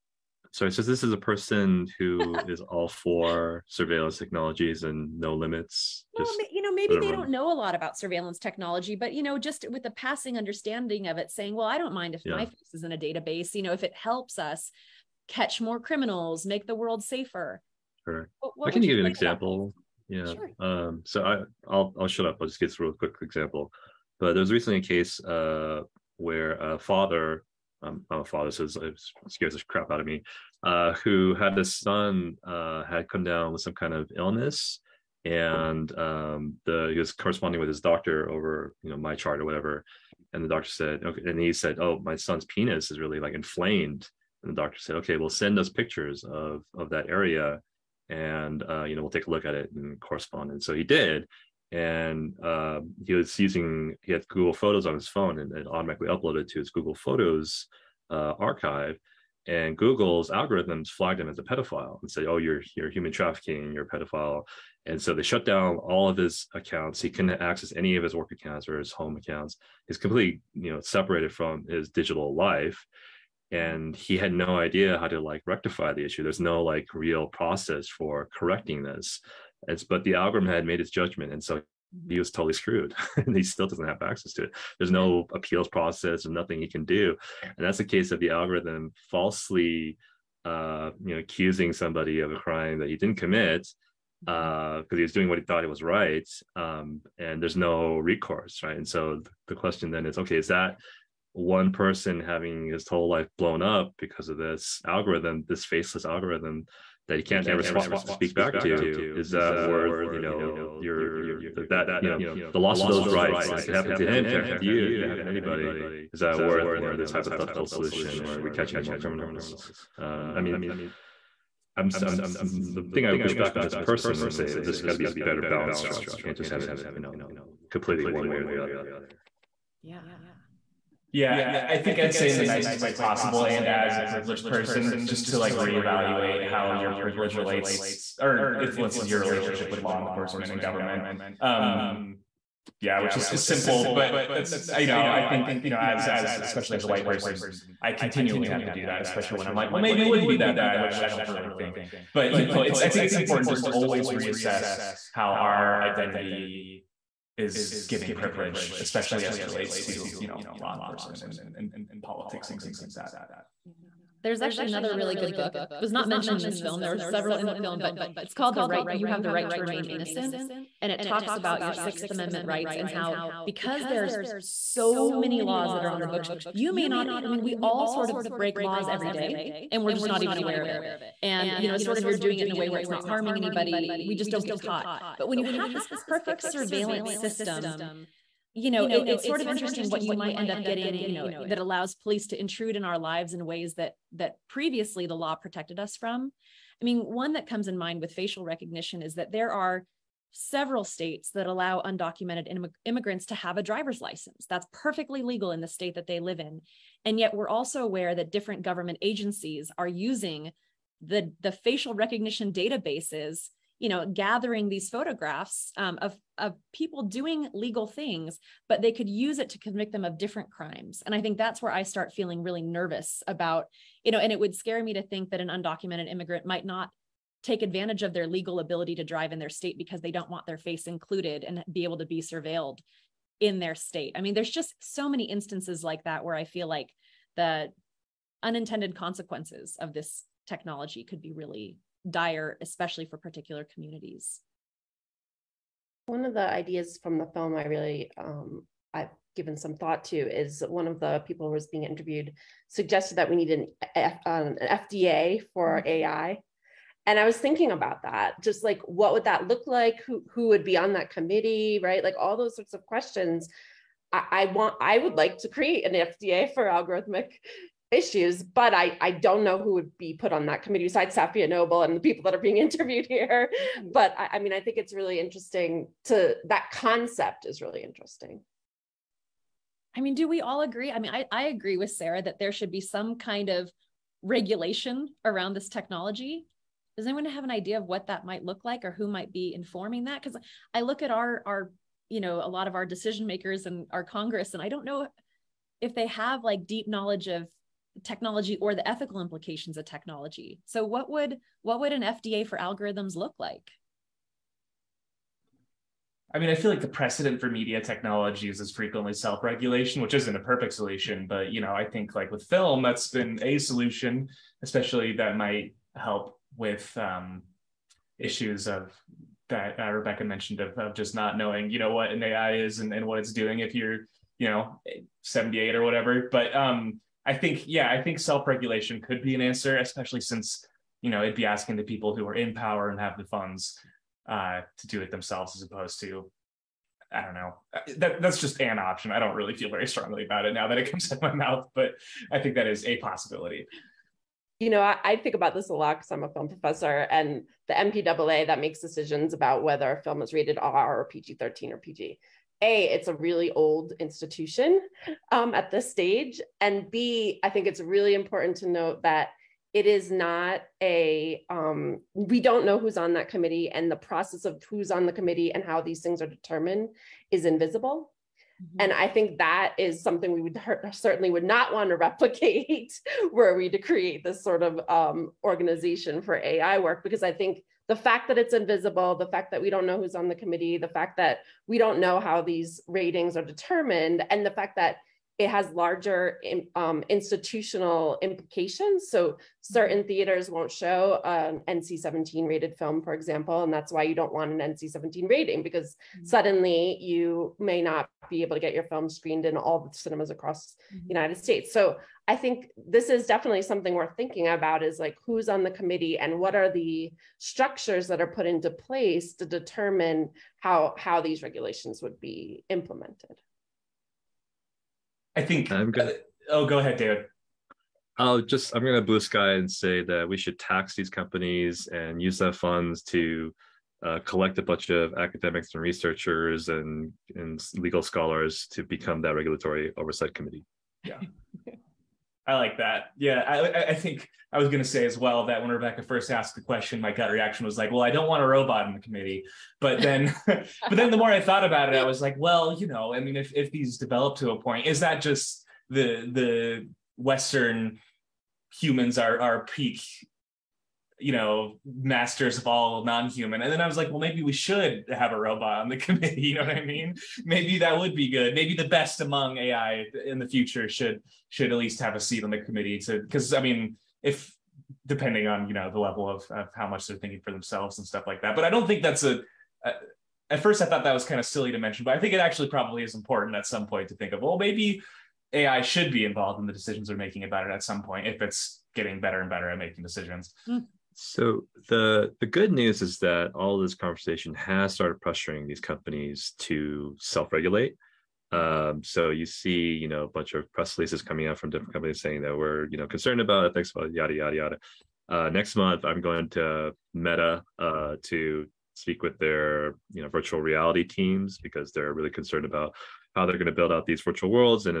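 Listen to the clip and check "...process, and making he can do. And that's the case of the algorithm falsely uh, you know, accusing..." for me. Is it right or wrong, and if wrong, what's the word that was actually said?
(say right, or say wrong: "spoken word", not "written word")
wrong: "nothing", not "making".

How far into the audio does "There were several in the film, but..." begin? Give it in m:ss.
2:46.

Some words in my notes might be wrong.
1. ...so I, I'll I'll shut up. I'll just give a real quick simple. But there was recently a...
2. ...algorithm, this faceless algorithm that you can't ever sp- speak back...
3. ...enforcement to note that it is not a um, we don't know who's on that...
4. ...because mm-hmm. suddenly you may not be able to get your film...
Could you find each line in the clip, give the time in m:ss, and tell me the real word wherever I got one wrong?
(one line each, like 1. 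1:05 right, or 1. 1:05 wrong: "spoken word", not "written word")
1. 0:21 wrong: "example", not "simple"
2. 1:44 right
3. 5:58 wrong: "important", not "enforcement"
4. 6:35 right.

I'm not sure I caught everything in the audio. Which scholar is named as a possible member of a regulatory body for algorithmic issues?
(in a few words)
Safiya Noble.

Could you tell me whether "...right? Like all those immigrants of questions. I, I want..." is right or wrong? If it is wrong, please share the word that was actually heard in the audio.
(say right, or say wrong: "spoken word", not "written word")
wrong: "sorts", not "immigrants".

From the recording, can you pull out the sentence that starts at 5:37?
Uh, that, that's just an option.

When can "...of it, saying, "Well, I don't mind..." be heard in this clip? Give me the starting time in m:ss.
0:11.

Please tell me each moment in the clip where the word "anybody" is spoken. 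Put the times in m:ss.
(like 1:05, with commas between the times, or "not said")
1:55, 3:03.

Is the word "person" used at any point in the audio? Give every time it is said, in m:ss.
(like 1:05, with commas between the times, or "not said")
0:01, 1:41, 2:03, 2:14, 2:27.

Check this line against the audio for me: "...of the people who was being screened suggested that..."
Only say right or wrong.
wrong.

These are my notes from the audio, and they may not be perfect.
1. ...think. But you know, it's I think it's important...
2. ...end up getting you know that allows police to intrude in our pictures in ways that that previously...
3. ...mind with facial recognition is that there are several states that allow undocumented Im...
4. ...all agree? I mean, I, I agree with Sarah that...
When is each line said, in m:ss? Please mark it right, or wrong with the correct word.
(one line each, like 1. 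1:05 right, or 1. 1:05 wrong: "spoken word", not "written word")
1. 2:31 right
2. 3:10 wrong: "lives", not "pictures"
3. 3:17 right
4. 4:40 right.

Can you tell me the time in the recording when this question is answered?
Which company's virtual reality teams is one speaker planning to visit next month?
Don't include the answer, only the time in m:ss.
8:17.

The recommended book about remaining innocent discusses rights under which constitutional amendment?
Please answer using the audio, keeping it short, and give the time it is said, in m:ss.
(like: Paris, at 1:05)
Sixth Amendment, at 2:51.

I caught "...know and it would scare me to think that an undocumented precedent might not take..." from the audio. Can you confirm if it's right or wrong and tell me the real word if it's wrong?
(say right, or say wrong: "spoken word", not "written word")
wrong: "immigrant", not "precedent".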